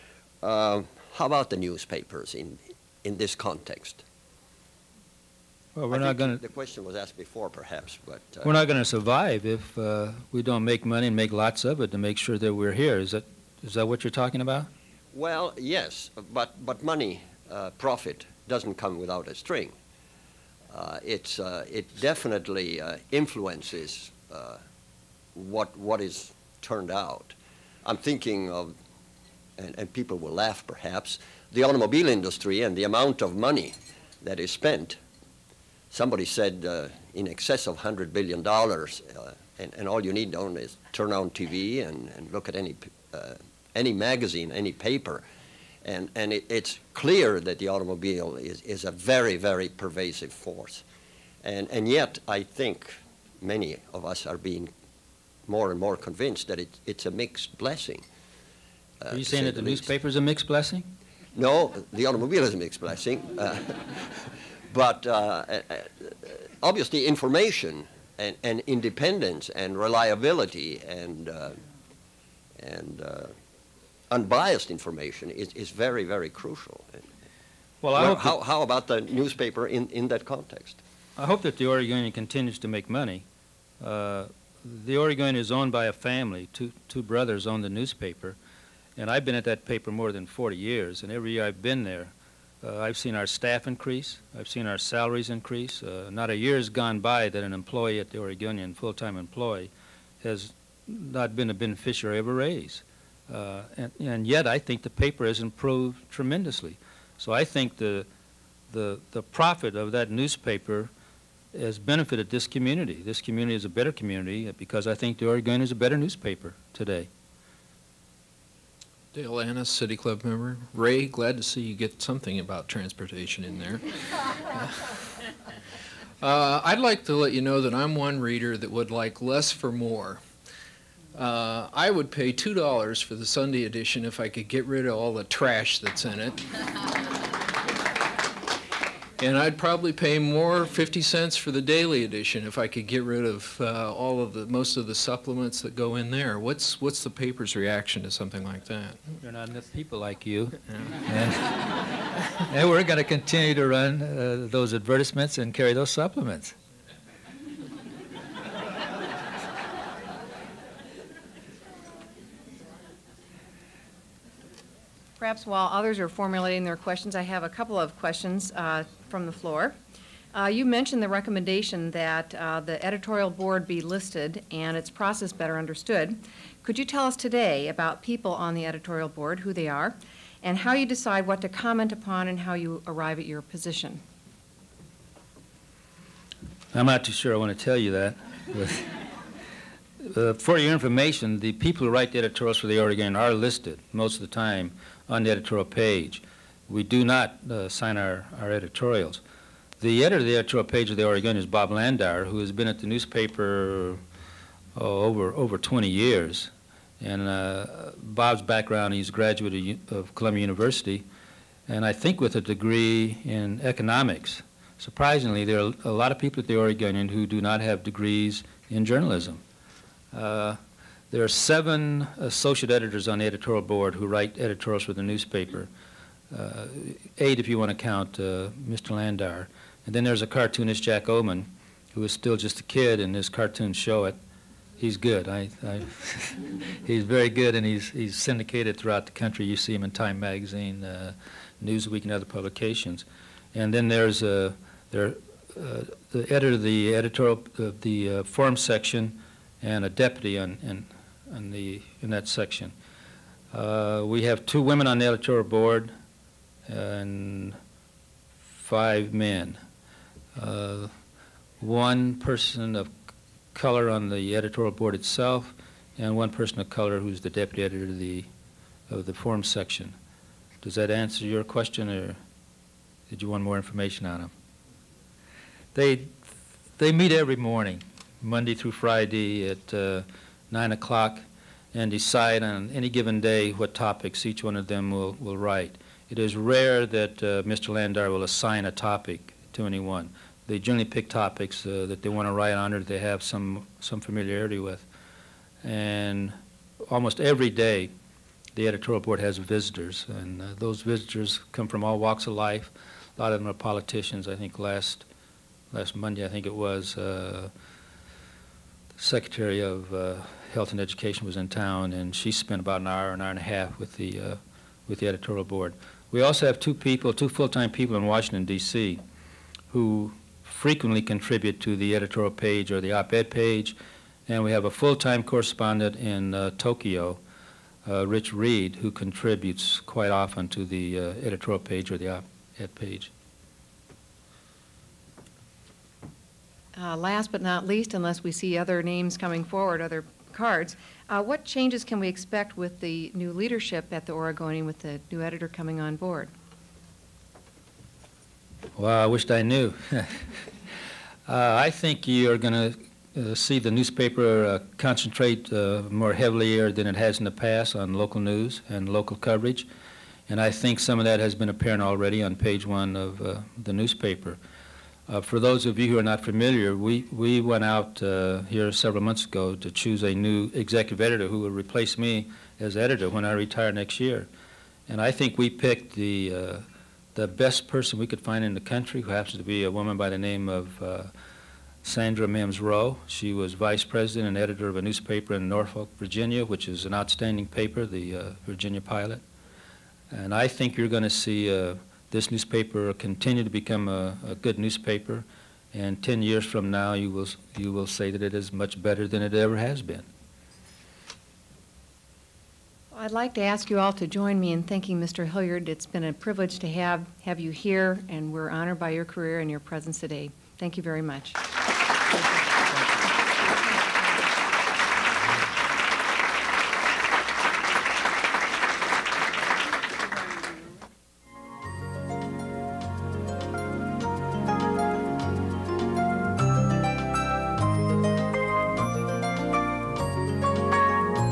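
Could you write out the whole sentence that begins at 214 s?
Surprisingly, there are a lot of people at the Oregonian who do not have degrees in journalism.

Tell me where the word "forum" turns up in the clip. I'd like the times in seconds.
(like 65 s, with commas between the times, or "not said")
248 s, 269 s.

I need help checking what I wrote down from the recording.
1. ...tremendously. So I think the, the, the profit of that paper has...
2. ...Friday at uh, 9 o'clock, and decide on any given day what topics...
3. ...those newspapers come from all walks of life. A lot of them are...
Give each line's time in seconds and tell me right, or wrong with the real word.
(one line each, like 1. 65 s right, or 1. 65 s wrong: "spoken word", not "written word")
1. 106 s wrong: "newspaper", not "paper"
2. 278 s right
3. 300 s wrong: "visitors", not "newspapers".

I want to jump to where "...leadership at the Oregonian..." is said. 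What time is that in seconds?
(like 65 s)
343 s.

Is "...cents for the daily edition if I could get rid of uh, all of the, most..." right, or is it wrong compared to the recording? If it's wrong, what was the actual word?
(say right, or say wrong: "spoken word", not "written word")
right.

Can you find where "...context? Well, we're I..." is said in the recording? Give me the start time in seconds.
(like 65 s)
3 s.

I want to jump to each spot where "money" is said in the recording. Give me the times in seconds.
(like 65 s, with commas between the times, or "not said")
10 s, 16 s, 33 s, 82 s.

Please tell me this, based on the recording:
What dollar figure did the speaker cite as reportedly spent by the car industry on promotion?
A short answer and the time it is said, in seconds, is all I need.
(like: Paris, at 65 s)
over $100 billion, at 37 s.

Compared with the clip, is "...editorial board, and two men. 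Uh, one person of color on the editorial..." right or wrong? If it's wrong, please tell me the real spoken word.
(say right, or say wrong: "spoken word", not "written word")
wrong: "five", not "two".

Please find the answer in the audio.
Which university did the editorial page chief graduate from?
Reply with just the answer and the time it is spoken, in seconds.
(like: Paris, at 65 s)
Columbia University, at 210 s.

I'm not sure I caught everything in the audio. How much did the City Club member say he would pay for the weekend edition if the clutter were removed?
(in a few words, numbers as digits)
$2.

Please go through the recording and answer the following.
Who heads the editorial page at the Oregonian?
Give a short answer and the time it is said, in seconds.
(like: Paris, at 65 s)
Bob Landauer, at 201 s.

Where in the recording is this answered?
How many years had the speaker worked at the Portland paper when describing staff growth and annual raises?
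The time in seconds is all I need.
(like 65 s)
89 s.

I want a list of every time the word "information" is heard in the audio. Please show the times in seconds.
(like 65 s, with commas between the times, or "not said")
67 s, 74 s, 190 s, 273 s.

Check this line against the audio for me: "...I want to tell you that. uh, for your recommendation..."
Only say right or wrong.
wrong.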